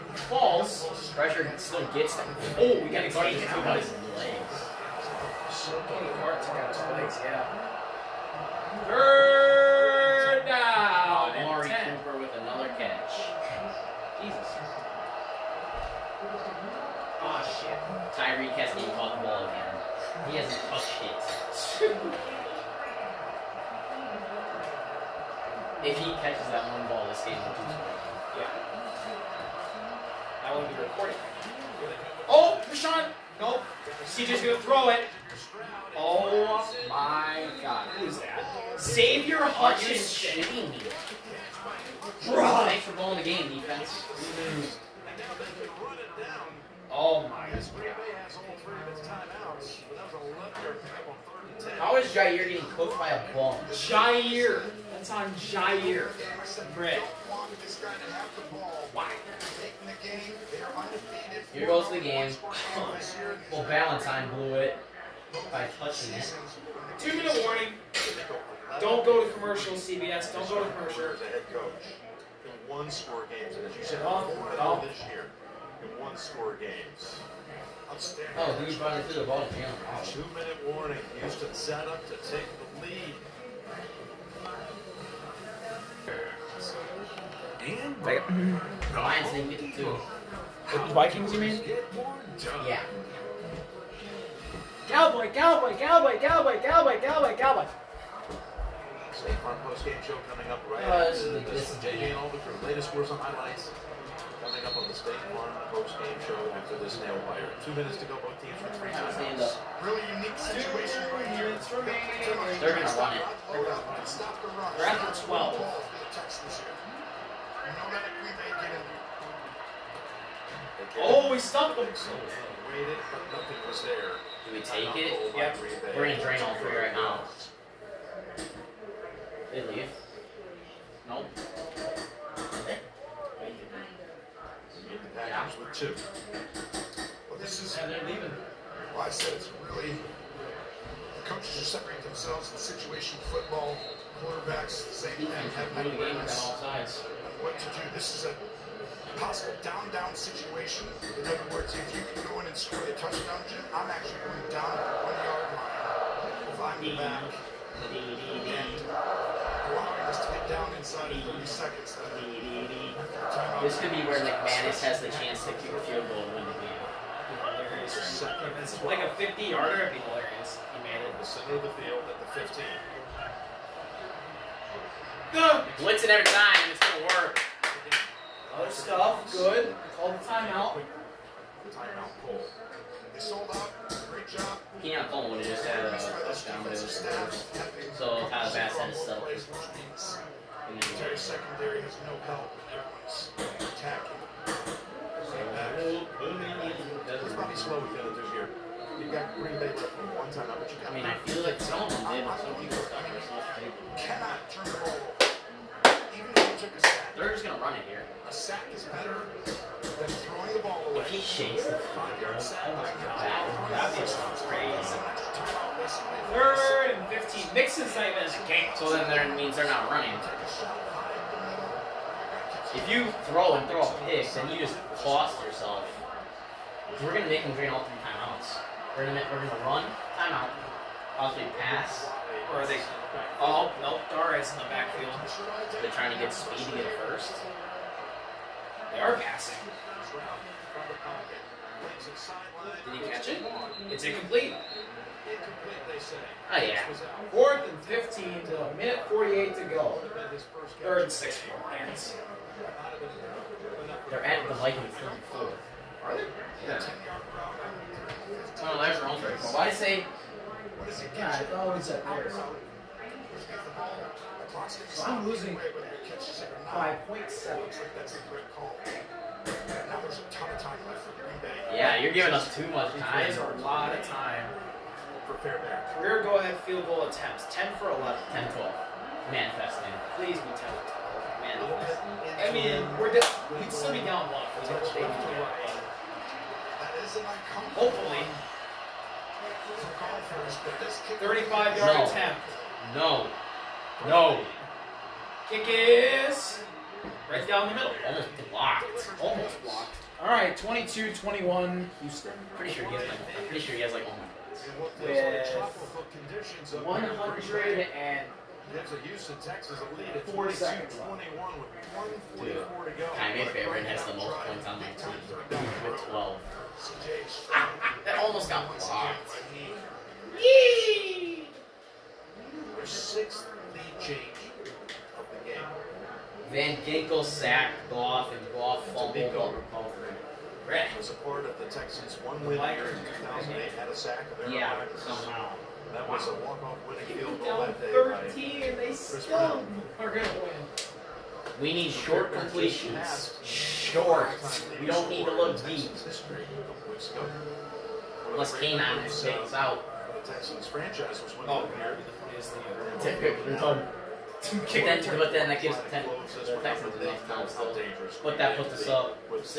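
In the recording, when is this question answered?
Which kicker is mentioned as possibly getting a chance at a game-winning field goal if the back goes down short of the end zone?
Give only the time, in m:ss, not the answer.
2:44.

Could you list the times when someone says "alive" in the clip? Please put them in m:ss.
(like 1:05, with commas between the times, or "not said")
not said.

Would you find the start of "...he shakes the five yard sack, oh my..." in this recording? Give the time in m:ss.
3:31.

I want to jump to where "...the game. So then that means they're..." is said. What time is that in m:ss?
3:38.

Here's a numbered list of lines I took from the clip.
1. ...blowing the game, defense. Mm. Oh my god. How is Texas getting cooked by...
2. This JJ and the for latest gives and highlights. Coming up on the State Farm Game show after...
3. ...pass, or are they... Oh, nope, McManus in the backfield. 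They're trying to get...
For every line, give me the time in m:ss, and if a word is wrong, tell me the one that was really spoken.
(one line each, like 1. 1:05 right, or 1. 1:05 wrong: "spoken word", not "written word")
1. 0:42 wrong: "Jaire", not "Texas"
2. 1:41 wrong: "scores", not "gives"
3. 3:51 wrong: "Darius", not "McManus".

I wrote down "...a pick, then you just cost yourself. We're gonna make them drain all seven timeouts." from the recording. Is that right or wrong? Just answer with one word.
wrong.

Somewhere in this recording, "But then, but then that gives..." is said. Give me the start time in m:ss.
5:54.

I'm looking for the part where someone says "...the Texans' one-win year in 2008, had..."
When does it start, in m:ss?
5:31.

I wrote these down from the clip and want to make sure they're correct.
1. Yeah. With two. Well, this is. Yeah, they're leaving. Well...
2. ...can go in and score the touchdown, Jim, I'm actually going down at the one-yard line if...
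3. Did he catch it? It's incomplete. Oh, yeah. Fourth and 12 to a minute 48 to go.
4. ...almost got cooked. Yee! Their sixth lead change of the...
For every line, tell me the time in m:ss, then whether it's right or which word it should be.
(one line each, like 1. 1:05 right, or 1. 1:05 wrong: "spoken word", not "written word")
1. 2:12 right
2. 2:32 right
3. 4:02 wrong: "15", not "12"
4. 5:18 wrong: "blocked", not "cooked".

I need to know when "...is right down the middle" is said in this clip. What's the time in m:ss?
4:55.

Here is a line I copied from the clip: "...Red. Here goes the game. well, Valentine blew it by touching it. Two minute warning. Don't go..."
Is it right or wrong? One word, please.
right.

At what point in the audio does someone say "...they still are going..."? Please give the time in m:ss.
5:38.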